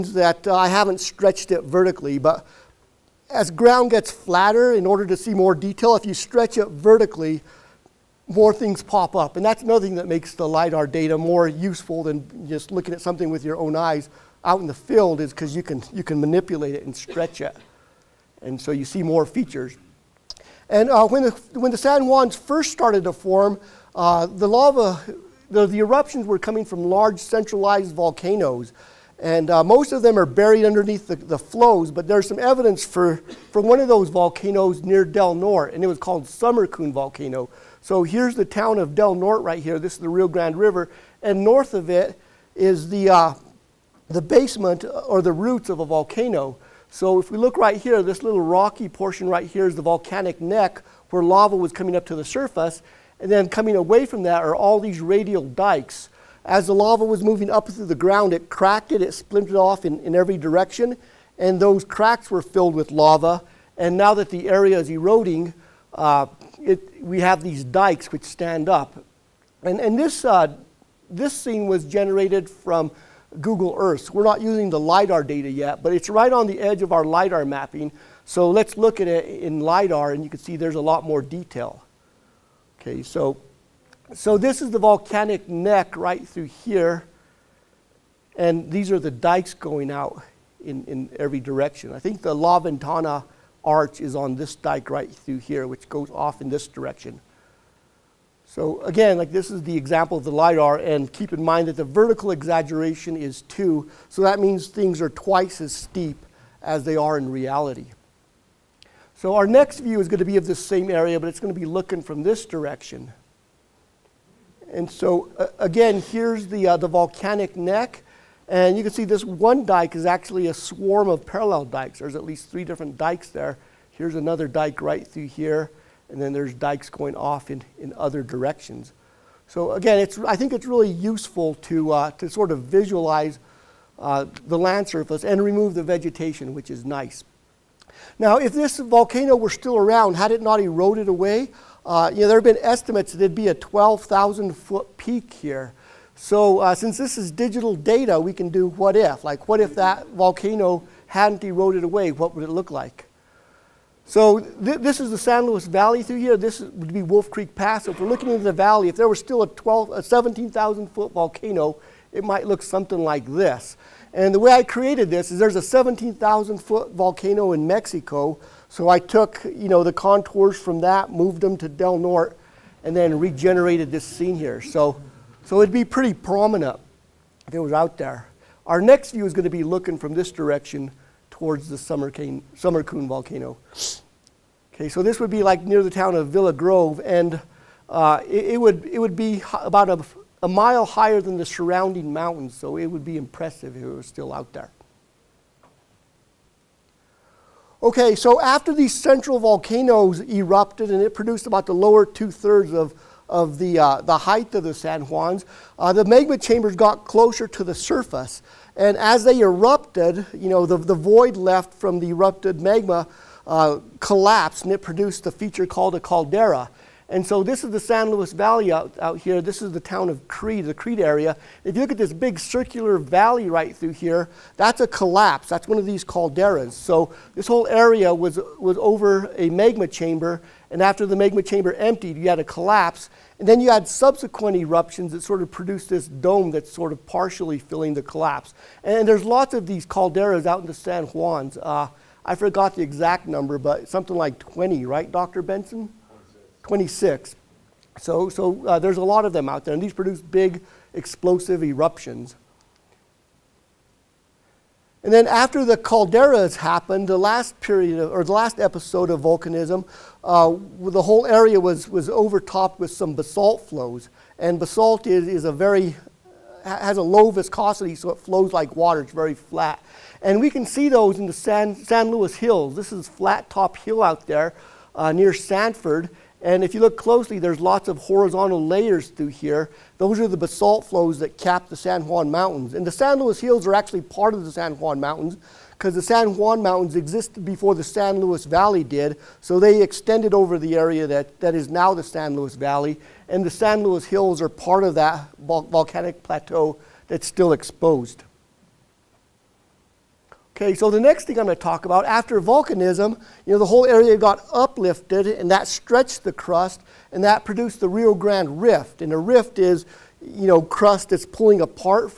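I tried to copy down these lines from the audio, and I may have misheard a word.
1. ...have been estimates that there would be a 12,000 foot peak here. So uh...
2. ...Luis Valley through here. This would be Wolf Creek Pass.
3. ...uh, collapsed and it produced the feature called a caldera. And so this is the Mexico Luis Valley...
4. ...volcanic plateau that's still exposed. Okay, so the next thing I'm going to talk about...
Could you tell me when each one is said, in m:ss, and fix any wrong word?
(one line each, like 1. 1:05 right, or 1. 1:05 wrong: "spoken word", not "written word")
1. 2:22 right
2. 2:35 right
3. 3:33 wrong: "San", not "Mexico"
4. 4:55 right.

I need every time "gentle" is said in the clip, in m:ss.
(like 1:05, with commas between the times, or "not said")
not said.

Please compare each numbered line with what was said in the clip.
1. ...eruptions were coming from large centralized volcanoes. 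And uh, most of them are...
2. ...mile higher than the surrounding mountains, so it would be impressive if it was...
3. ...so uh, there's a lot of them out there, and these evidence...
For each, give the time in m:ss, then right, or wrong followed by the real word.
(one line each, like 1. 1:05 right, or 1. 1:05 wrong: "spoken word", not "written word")
1. 0:25 right
2. 3:10 right
3. 4:08 wrong: "produce", not "evidence".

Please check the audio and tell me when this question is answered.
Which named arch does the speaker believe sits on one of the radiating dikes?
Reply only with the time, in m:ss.
1:32.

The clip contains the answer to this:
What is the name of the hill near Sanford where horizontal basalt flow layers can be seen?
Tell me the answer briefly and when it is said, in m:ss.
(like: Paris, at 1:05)
Flat Top Hill, at 4:33.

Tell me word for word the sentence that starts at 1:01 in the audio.
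And those cracks were filled with lava.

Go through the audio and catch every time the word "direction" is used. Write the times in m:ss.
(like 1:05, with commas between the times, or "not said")
1:00, 1:31, 1:36, 1:52, 2:08, 3:00.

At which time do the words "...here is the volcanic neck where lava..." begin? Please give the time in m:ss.
0:49.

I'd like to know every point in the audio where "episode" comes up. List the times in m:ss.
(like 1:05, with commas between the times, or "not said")
4:18.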